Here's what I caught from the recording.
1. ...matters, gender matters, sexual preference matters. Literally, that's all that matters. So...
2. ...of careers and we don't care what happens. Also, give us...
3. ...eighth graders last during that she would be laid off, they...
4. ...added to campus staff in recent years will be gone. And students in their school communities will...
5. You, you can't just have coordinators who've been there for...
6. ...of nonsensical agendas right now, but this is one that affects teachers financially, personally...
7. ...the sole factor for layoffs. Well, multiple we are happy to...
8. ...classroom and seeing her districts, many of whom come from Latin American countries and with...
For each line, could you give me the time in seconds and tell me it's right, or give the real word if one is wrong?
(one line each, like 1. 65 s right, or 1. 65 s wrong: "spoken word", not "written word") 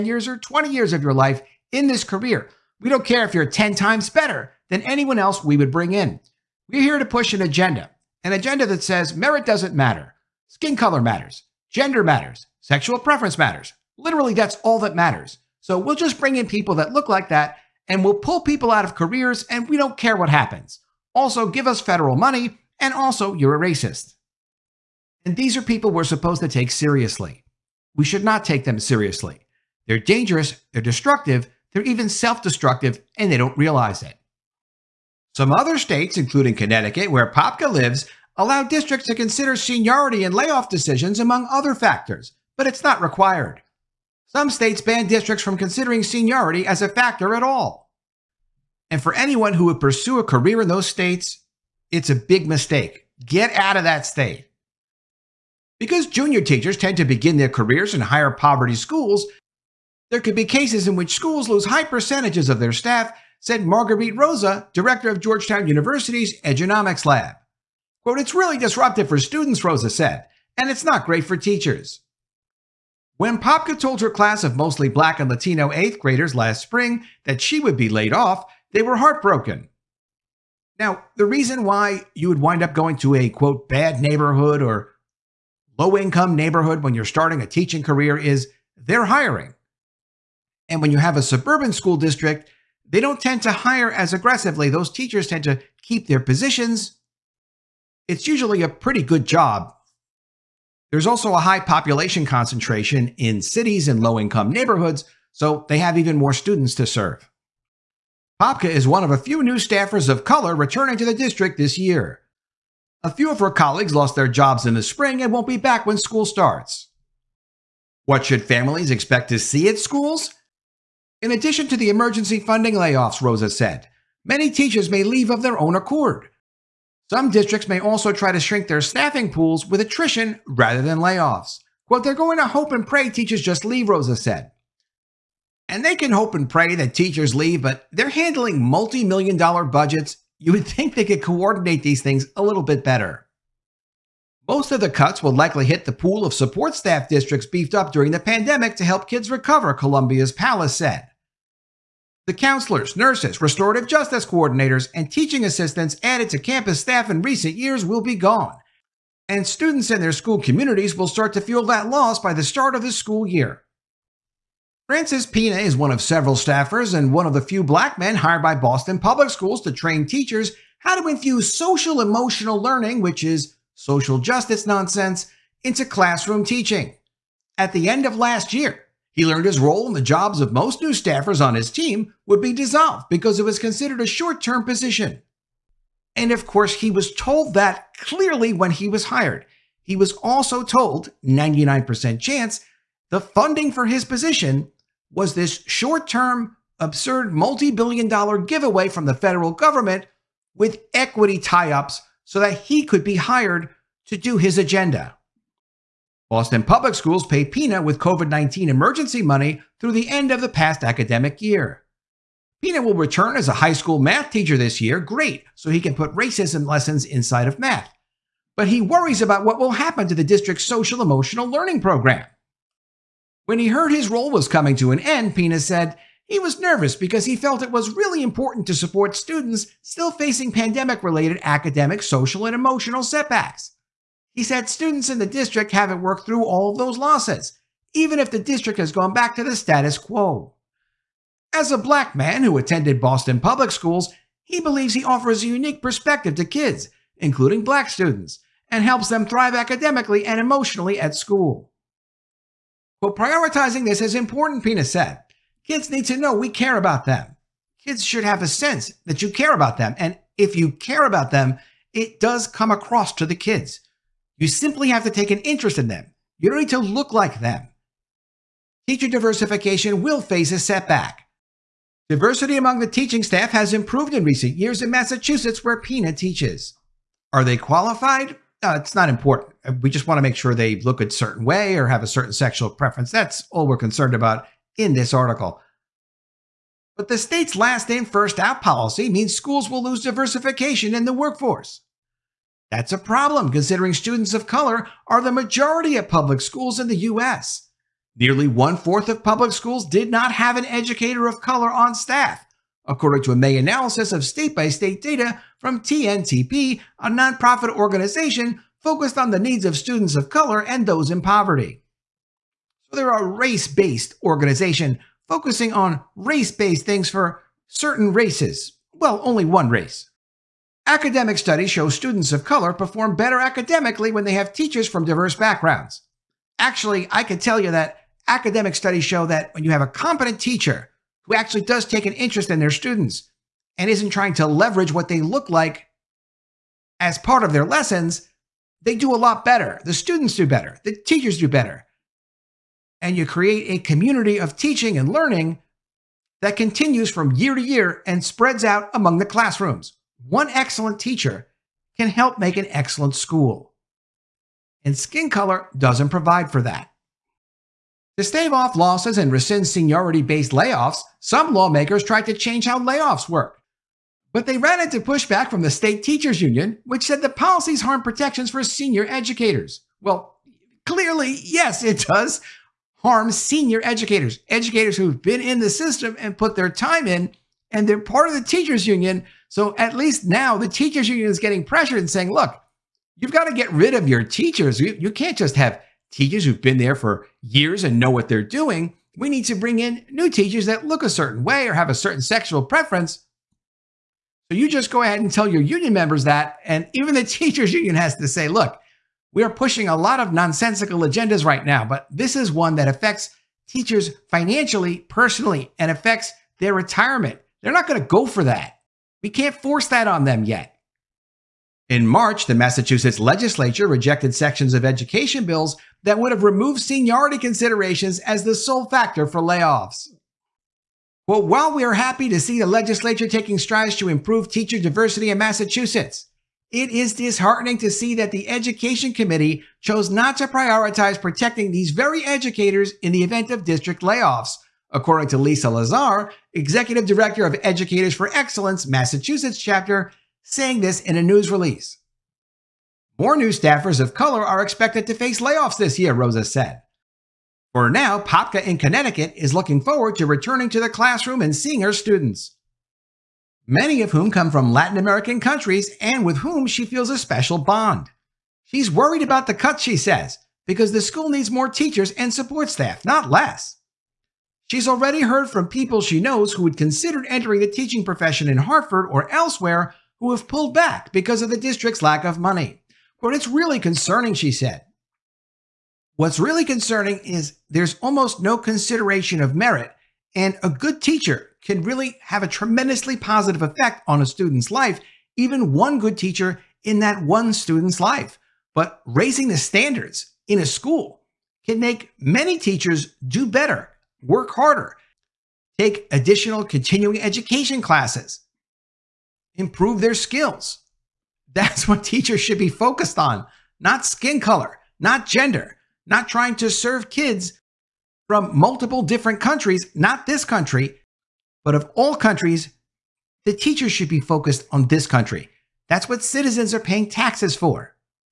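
1. 11 s right
2. 18 s right
3. 75 s wrong: "spring", not "during"
4. 156 s right
5. 384 s wrong: "teachers", not "coordinators"
6. 400 s right
7. 418 s wrong: "while", not "multiple"
8. 450 s wrong: "students", not "districts".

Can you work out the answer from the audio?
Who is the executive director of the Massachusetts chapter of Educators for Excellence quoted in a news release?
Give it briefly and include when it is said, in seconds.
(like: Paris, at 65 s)
Lisa Lazar, at 435 s.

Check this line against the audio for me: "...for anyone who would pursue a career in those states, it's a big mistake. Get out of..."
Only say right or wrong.
right.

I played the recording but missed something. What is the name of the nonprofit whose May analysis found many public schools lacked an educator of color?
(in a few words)
TNTP.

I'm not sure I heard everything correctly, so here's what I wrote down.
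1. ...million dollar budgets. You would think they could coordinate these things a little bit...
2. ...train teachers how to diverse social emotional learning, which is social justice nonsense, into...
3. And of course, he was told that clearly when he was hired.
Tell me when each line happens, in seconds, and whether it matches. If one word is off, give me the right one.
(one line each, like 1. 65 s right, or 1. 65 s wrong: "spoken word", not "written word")
1. 139 s right
2. 169 s wrong: "infuse", not "diverse"
3. 186 s right.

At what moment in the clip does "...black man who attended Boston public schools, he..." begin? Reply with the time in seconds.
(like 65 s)
241 s.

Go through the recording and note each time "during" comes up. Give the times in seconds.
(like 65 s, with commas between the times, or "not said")
147 s.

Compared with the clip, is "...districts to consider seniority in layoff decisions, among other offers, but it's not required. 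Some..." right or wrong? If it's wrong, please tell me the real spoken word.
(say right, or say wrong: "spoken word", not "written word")
wrong: "factors", not "offers".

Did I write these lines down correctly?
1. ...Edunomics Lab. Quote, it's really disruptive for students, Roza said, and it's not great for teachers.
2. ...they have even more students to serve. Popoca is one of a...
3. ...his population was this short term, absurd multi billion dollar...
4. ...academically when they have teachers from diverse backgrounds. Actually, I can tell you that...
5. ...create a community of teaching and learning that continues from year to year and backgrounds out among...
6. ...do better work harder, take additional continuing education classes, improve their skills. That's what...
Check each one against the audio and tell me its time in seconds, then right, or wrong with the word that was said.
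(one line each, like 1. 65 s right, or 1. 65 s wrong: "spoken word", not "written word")
1. 66 s right
2. 105 s right
3. 193 s wrong: "position", not "population"
4. 323 s right
5. 343 s wrong: "spreads", not "backgrounds"
6. 493 s right.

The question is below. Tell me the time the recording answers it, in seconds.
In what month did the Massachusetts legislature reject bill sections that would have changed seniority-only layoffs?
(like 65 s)
412 s.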